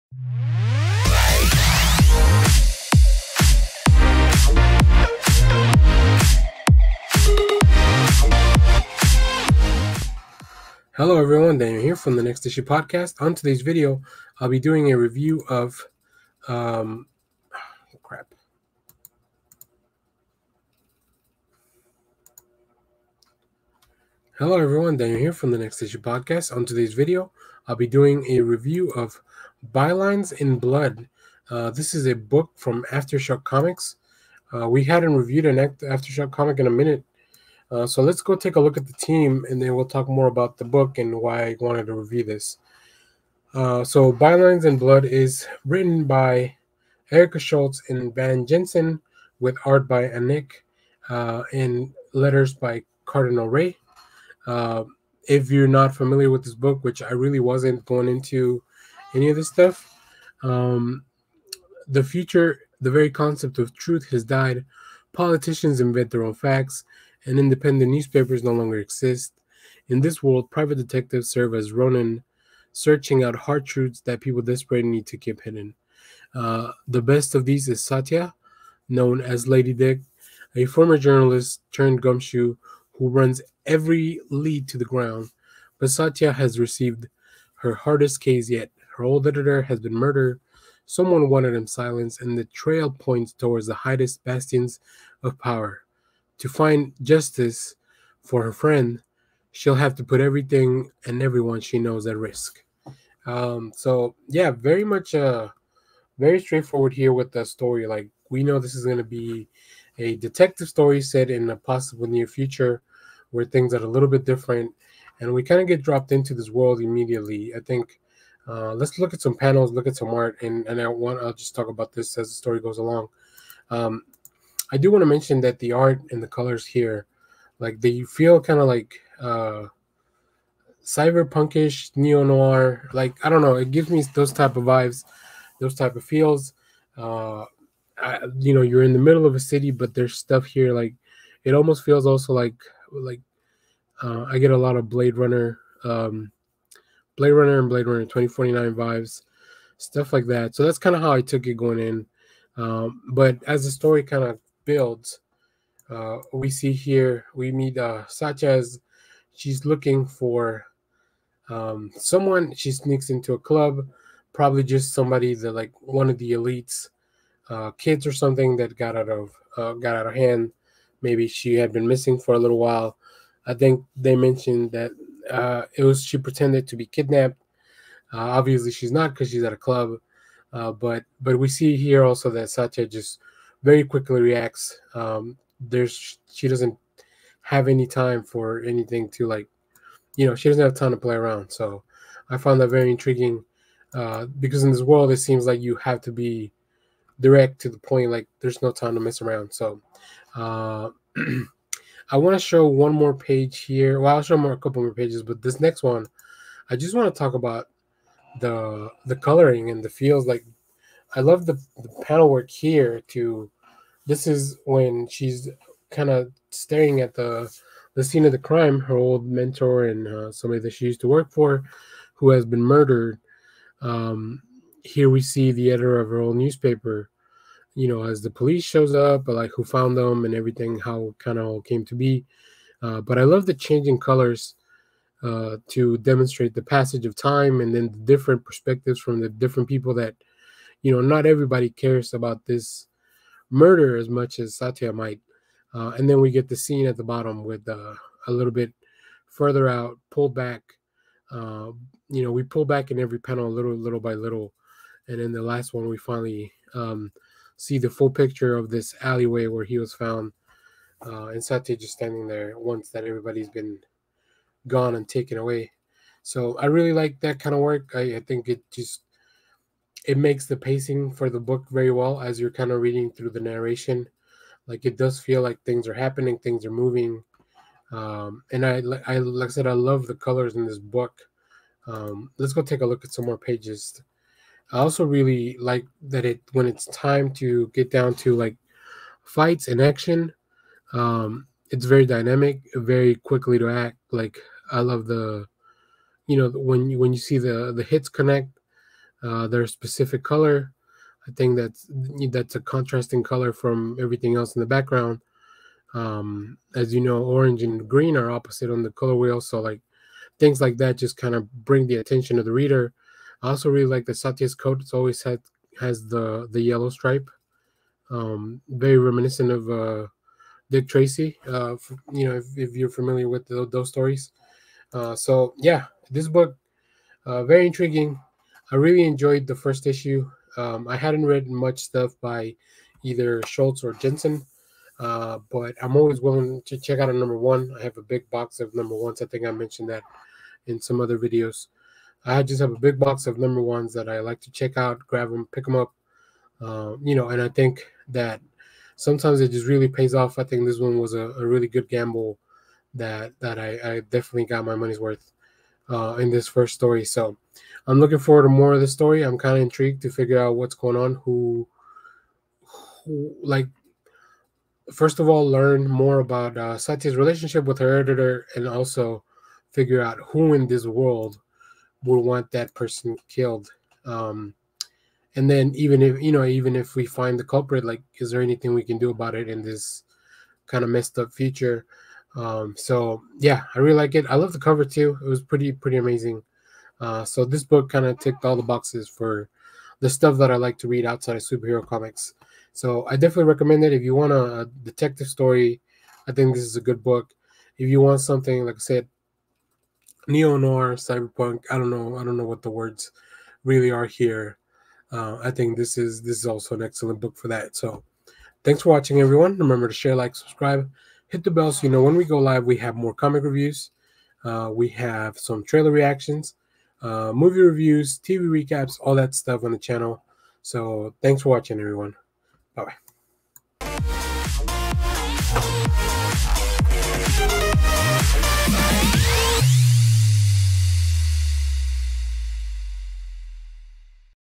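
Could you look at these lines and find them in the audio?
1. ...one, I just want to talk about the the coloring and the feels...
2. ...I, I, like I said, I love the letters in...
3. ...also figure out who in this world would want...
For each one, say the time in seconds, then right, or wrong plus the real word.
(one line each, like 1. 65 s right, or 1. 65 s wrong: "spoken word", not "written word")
1. 205 s right
2. 278 s wrong: "colors", not "letters"
3. 368 s right.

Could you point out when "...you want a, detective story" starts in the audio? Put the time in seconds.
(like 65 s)
394 s.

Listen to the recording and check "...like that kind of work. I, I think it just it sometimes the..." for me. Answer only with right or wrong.
wrong.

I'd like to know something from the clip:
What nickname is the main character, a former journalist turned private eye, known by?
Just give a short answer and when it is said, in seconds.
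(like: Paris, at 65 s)
Lady Dick, at 79 s.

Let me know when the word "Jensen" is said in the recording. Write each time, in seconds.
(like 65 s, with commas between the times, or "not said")
48 s, 333 s.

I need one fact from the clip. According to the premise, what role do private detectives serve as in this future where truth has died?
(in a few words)
Ronin.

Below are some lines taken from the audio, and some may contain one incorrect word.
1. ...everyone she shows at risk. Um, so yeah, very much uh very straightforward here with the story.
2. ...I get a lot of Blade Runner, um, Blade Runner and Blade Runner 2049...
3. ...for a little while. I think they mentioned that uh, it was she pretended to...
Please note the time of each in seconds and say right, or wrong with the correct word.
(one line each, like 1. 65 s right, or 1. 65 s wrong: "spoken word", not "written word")
1. 101 s wrong: "knows", not "shows"
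2. 144 s right
3. 172 s right.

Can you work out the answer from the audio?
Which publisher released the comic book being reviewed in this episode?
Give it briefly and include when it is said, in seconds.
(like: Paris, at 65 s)
Aftershock Comics, at 32 s.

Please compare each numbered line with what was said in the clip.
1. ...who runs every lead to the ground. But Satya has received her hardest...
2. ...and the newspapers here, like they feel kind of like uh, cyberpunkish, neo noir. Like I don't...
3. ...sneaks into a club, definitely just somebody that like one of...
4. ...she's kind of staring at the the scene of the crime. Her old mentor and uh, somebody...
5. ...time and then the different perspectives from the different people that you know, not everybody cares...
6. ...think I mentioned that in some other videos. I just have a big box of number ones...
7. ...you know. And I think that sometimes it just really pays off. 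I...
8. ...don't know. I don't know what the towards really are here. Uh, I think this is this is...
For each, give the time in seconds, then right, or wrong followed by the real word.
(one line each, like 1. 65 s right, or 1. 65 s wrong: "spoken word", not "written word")
1. 82 s right
2. 126 s wrong: "colors", not "newspapers"
3. 162 s wrong: "probably", not "definitely"
4. 215 s right
5. 237 s right
6. 339 s right
7. 347 s right
8. 401 s wrong: "words", not "towards".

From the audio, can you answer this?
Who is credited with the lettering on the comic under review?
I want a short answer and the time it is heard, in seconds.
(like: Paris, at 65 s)
Cardinal Rae, at 53 s.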